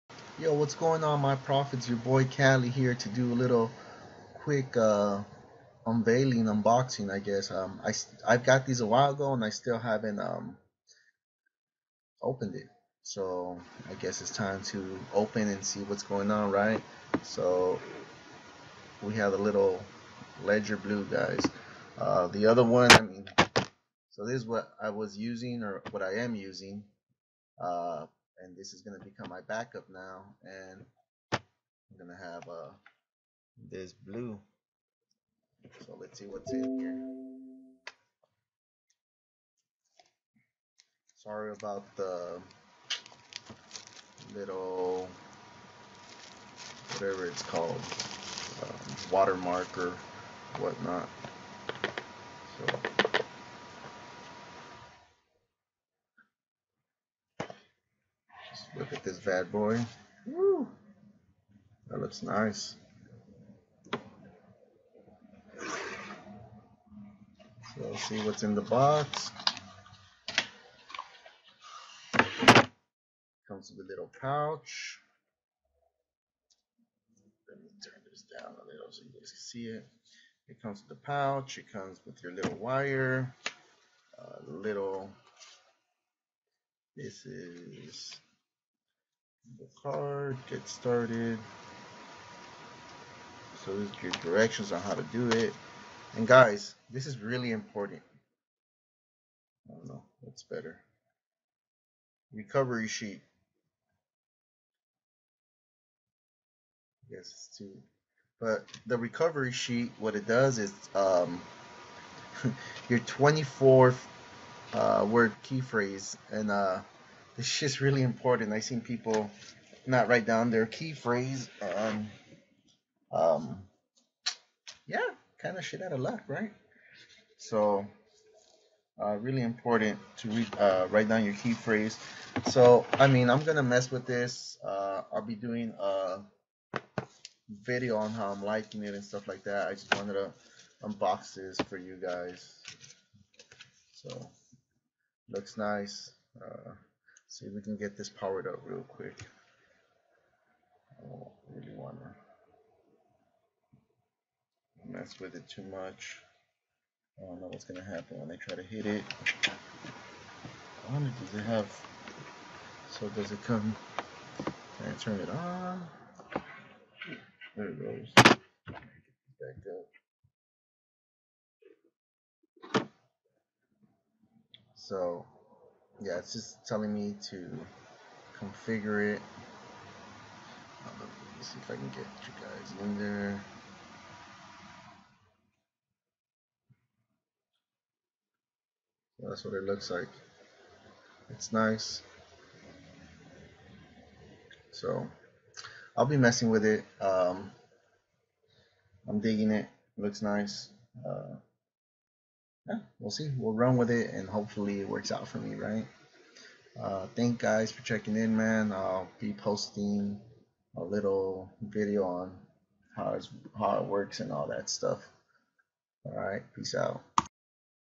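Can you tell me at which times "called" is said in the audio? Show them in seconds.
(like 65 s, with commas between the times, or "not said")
47 s.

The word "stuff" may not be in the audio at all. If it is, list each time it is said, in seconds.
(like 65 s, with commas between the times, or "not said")
139 s, 214 s.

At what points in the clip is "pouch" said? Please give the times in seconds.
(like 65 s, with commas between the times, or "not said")
74 s, 81 s.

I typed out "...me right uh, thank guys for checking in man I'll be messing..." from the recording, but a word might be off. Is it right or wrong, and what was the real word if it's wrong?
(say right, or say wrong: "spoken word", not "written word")
wrong: "posting", not "messing".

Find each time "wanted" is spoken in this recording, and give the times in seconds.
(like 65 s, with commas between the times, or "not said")
139 s.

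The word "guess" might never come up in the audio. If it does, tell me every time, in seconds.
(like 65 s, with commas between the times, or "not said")
7 s, 14 s.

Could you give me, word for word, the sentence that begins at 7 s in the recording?
Um, I, I've got these a while ago and I still haven't um, opened it.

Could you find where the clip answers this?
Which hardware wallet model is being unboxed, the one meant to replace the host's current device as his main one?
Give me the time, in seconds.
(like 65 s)
20 s.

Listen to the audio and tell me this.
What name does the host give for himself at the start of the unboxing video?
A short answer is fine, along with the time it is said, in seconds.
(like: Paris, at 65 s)
Cali, at 2 s.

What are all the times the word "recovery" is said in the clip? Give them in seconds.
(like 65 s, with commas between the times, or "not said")
102 s, 108 s.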